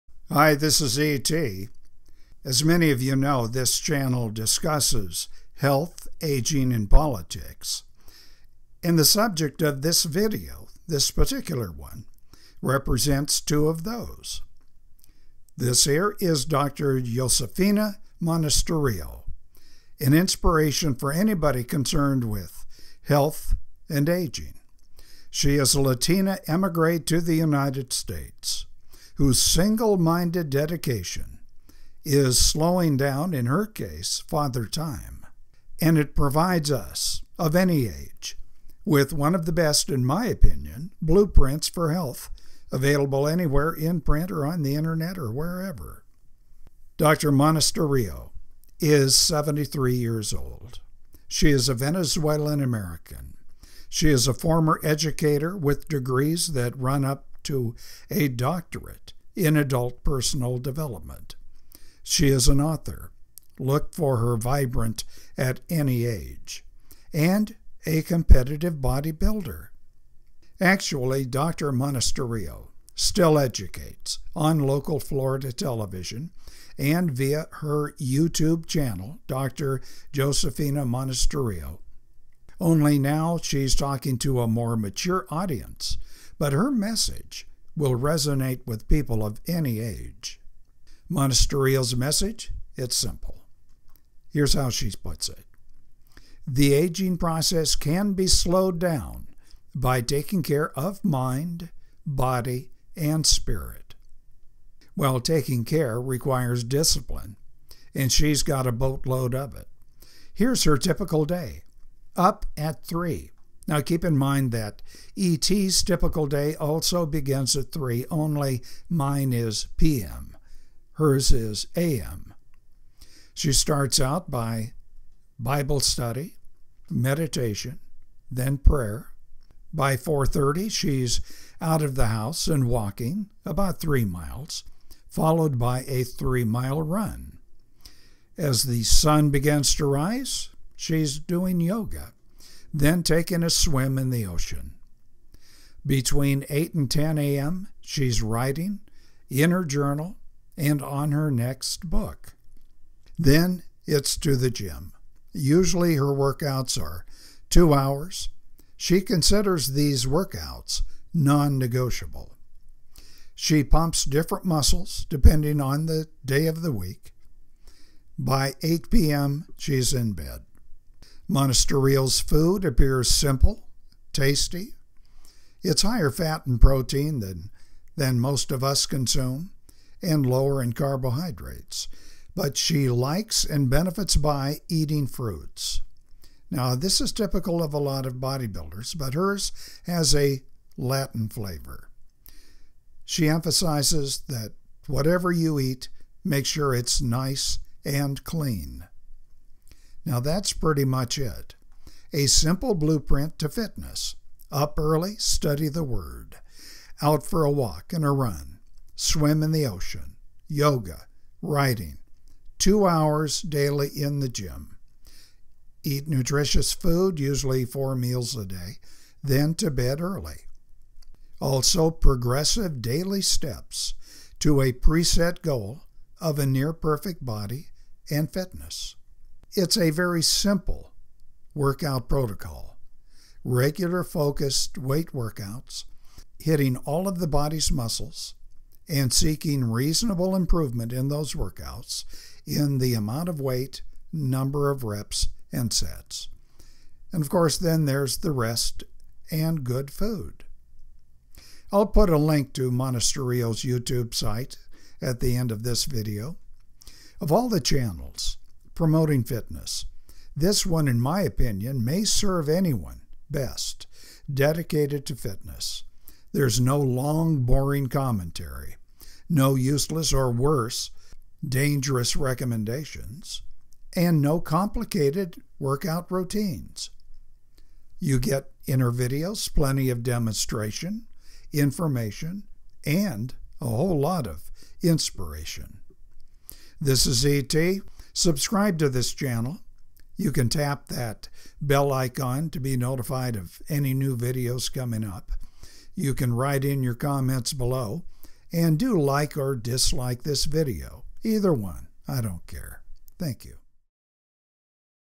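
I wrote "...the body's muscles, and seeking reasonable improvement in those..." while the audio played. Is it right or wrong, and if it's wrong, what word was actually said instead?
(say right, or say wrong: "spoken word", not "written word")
right.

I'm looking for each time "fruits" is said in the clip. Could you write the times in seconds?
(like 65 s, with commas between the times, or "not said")
185 s.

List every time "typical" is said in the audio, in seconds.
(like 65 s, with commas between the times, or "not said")
110 s, 115 s, 187 s.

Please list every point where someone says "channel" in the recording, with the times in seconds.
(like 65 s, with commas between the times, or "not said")
3 s, 78 s, 257 s, 289 s.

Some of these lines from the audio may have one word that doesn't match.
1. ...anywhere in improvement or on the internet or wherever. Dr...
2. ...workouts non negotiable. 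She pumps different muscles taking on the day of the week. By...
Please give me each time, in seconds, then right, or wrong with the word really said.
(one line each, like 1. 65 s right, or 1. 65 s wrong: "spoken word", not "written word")
1. 43 s wrong: "print", not "improvement"
2. 160 s wrong: "depending", not "taking".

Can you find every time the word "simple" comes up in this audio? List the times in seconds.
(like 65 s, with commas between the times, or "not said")
92 s, 173 s, 202 s, 230 s.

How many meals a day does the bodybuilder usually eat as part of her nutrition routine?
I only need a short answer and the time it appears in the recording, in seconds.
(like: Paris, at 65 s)
4, at 217 s.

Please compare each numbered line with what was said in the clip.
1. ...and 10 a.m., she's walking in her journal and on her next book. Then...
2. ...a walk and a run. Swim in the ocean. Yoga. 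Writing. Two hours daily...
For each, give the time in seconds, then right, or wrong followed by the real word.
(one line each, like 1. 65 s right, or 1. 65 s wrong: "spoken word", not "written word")
1. 146 s wrong: "writing", not "walking"
2. 207 s right.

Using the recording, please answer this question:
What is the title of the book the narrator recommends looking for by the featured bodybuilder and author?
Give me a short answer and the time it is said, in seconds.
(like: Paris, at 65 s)
Vibrant at Any Age, at 64 s.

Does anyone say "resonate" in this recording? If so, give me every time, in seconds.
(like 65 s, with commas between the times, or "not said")
87 s.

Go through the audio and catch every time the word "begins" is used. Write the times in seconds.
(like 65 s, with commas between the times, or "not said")
117 s, 139 s.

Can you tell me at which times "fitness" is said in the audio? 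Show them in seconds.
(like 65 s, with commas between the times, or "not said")
203 s, 228 s, 259 s, 265 s.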